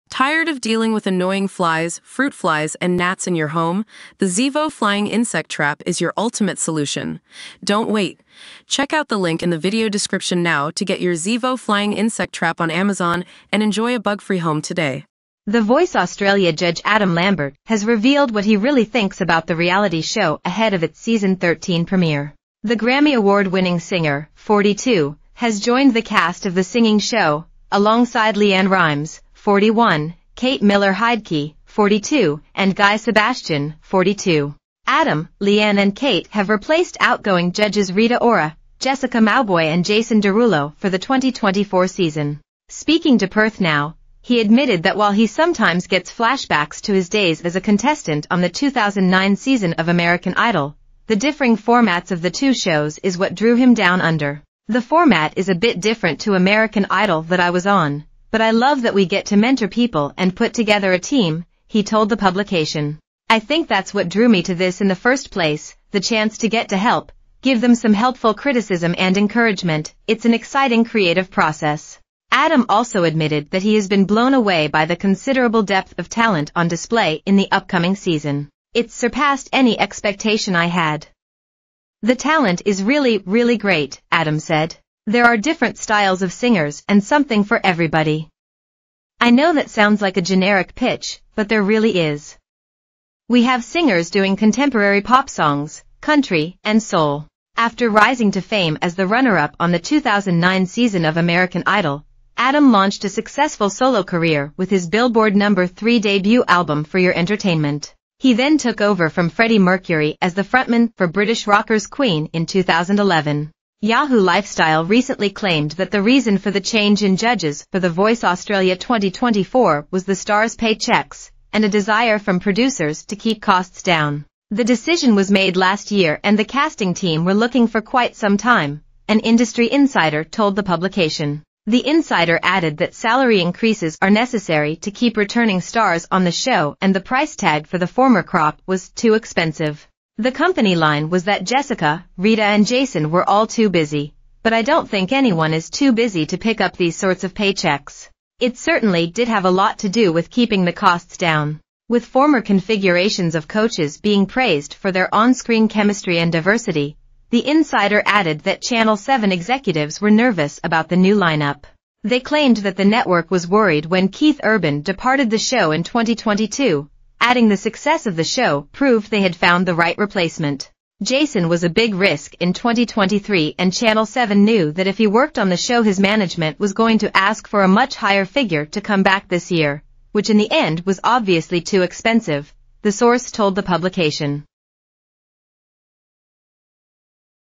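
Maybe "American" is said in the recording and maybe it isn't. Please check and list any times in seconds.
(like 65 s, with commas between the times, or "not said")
49 s, 56 s, 101 s.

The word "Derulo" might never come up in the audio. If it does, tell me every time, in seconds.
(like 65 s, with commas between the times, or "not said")
40 s.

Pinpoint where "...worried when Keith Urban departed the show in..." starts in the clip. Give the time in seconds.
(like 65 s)
163 s.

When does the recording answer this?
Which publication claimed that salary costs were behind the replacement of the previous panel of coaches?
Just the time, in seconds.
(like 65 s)
113 s.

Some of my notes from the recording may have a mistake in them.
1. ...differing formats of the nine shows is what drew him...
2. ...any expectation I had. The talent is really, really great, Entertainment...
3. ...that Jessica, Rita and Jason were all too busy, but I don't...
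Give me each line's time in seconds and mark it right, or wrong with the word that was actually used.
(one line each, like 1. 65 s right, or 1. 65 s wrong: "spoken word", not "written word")
1. 51 s wrong: "two", not "nine"
2. 79 s wrong: "Adam", not "Entertainment"
3. 141 s right.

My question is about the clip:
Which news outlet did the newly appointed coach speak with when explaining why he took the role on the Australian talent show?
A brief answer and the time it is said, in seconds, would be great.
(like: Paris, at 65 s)
Perth Now, at 43 s.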